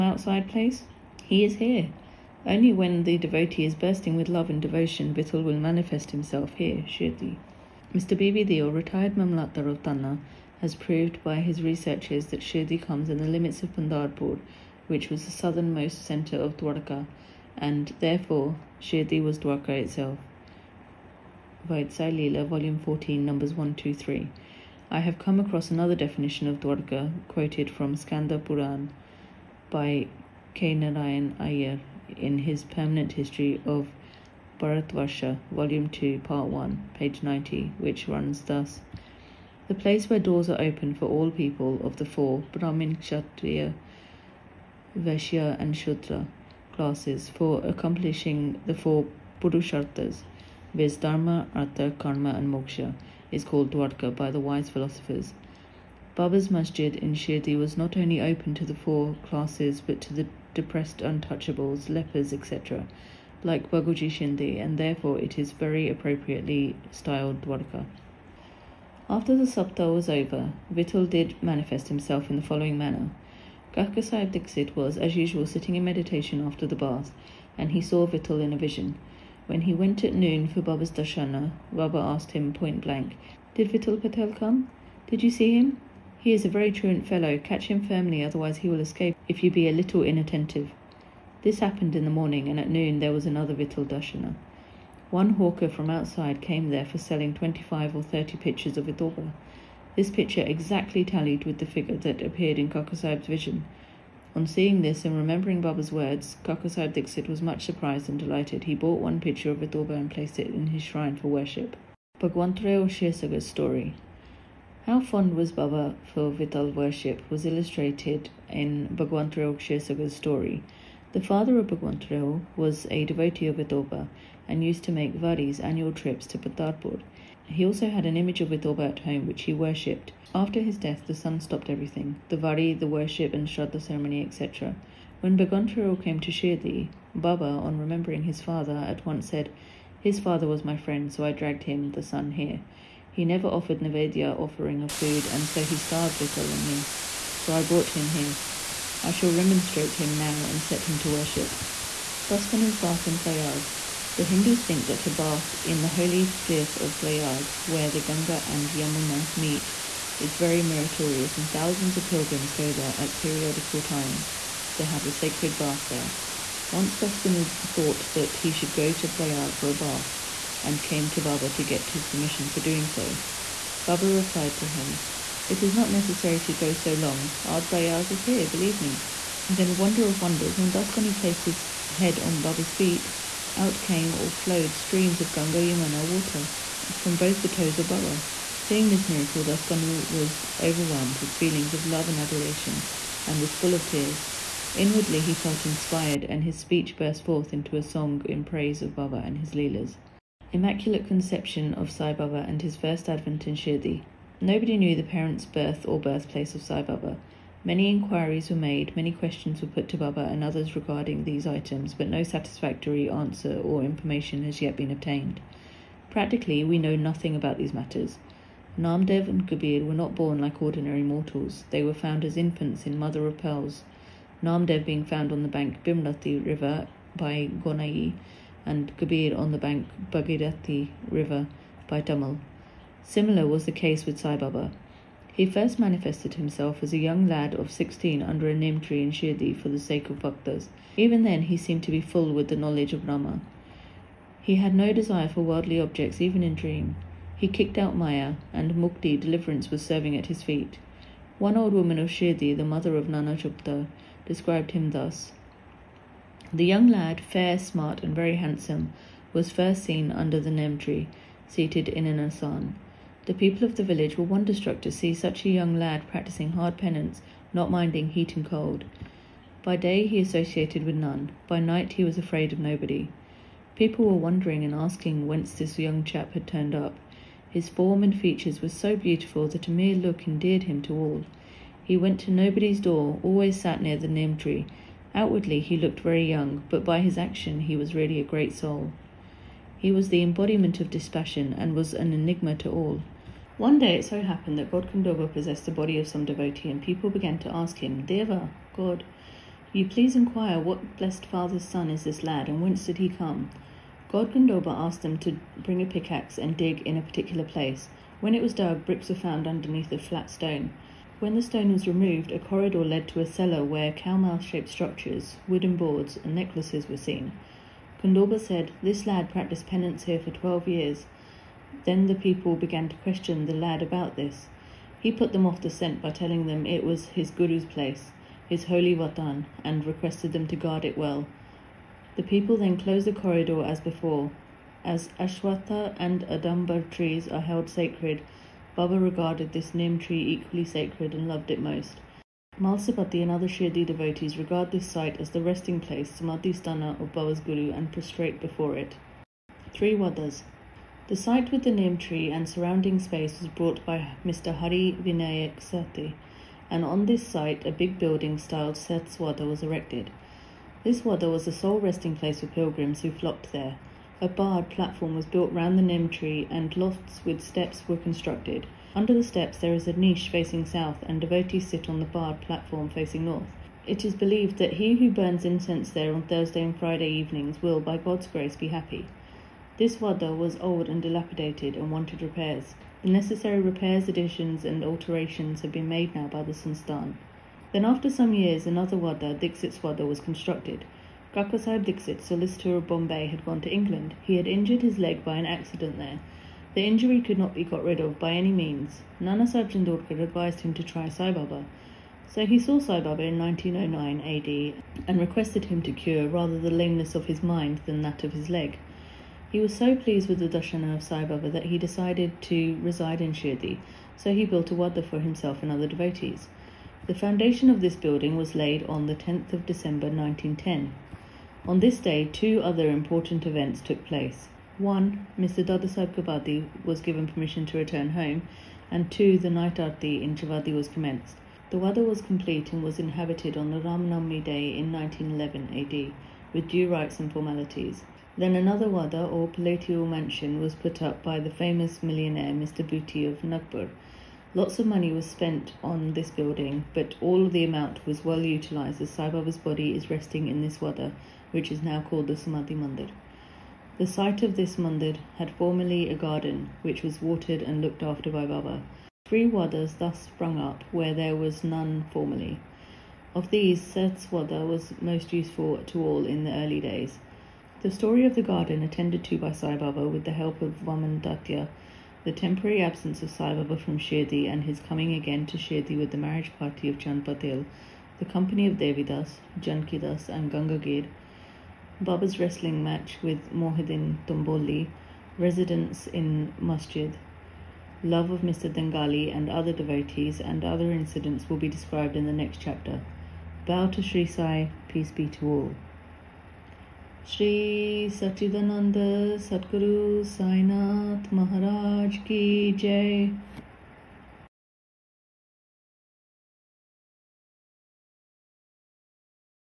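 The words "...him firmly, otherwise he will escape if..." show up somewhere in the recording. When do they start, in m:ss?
1:27.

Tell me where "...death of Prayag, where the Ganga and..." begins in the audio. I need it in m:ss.
2:36.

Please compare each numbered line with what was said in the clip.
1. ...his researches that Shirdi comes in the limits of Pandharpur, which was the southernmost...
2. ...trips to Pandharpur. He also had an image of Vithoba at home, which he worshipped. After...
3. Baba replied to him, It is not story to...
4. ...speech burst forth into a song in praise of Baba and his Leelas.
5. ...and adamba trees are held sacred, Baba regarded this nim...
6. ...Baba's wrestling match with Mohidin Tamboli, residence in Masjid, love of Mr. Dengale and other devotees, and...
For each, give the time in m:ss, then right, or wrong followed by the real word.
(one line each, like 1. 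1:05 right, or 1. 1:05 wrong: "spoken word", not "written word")
1. 0:11 right
2. 2:05 right
3. 2:53 wrong: "necessary", not "story"
4. 3:16 right
5. 5:35 right
6. 8:02 right.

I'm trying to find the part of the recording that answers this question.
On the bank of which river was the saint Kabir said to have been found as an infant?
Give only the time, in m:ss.
3:50.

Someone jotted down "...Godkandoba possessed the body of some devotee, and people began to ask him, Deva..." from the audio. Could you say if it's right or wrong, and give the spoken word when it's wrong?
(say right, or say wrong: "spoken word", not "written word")
right.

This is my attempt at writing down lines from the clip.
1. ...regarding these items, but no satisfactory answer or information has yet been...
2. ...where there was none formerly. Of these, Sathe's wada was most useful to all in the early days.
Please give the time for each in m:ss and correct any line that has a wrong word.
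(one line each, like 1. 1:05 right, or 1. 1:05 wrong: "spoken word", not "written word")
1. 3:30 right
2. 7:40 right.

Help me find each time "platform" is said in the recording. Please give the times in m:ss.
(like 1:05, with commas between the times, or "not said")
6:04, 6:12.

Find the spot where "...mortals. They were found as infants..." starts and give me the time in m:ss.
3:41.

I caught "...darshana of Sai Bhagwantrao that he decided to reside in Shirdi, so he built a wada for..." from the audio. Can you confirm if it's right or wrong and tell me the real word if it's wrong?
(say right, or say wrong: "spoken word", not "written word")
wrong: "Baba", not "Bhagwantrao".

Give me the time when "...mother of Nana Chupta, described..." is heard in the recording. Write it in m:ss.
4:12.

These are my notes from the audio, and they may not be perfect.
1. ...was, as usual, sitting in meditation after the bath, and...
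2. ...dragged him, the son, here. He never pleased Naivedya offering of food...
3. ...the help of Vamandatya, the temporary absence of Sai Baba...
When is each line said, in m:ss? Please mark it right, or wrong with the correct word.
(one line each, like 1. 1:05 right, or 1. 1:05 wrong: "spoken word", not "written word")
1. 1:14 right
2. 2:21 wrong: "offered", not "pleased"
3. 7:50 right.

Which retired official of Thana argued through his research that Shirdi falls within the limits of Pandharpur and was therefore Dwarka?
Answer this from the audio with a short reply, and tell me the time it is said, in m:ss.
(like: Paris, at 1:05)
Bibi Deol, at 0:08.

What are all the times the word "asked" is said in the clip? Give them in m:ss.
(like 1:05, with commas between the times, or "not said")
1:21, 5:04.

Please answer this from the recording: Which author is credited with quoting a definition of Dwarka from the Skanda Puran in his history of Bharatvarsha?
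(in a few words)
K. Narayan Ayer.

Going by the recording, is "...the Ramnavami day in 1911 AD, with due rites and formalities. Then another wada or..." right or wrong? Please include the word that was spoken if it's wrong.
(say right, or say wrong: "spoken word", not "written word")
right.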